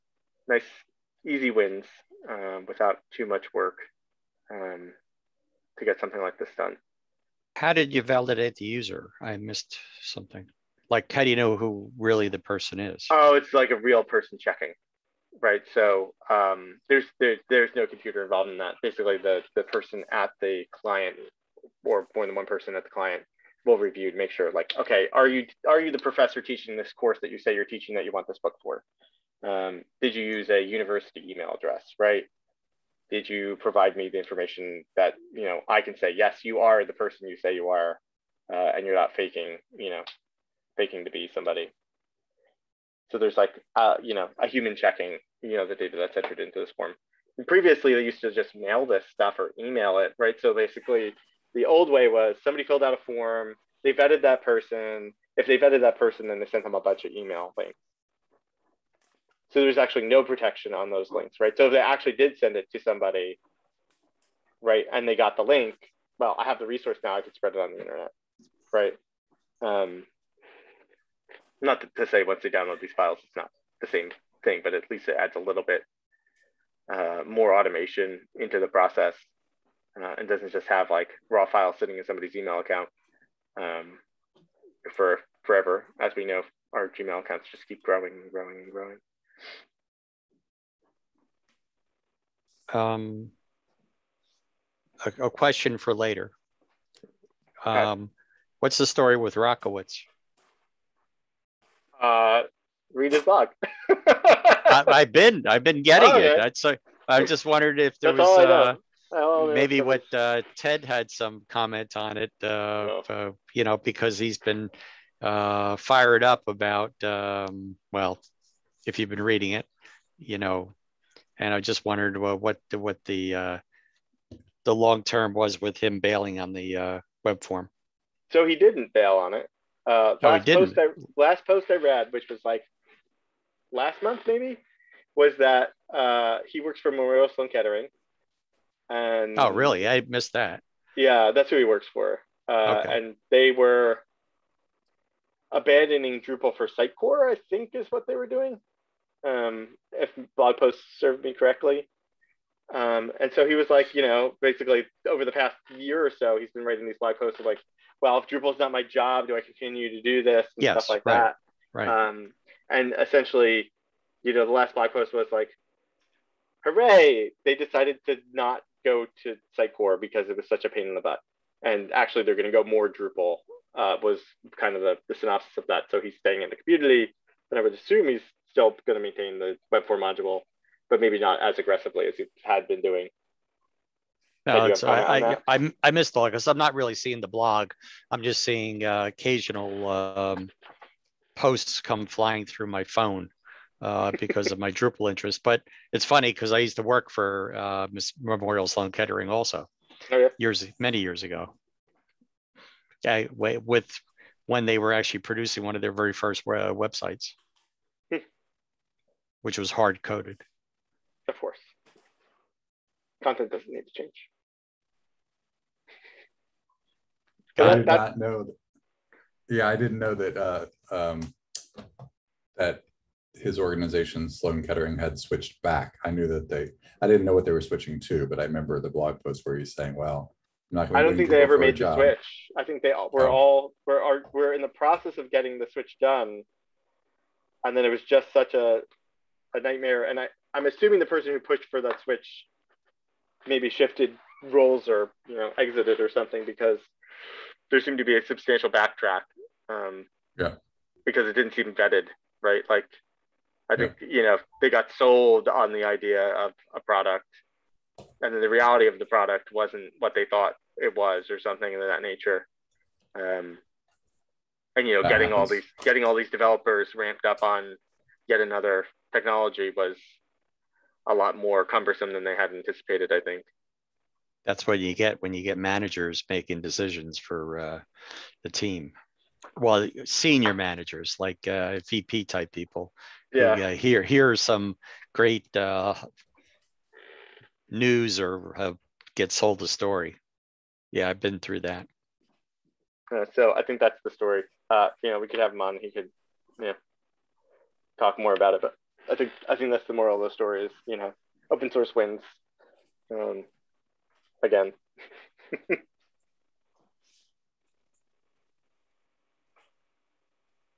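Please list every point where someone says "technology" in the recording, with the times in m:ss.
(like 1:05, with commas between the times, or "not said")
4:29.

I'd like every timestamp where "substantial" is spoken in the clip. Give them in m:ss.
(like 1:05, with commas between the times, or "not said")
4:08.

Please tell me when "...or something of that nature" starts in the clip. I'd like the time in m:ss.
4:21.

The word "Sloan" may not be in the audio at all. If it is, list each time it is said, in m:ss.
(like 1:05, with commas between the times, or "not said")
2:17, 3:18, 3:44.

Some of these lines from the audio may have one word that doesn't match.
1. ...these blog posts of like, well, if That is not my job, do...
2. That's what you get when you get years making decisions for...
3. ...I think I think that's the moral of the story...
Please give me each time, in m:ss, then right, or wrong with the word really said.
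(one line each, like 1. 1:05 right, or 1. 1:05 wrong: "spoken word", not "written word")
1. 2:36 wrong: "Drupal", not "That"
2. 4:34 wrong: "managers", not "years"
3. 4:59 right.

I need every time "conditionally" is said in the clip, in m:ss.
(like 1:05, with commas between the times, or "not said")
not said.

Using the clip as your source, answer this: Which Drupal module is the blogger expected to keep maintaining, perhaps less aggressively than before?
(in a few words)
Webform.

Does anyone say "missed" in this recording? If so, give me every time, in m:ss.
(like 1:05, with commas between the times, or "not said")
0:09, 2:20, 3:05.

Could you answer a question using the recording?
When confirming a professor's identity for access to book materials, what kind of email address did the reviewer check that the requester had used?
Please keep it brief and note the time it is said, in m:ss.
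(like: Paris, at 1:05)
university email address, at 0:30.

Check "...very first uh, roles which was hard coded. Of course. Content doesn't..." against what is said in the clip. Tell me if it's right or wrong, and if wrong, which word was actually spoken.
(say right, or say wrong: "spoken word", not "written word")
wrong: "websites", not "roles".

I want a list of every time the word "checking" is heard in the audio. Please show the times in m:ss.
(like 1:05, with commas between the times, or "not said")
0:14, 0:44.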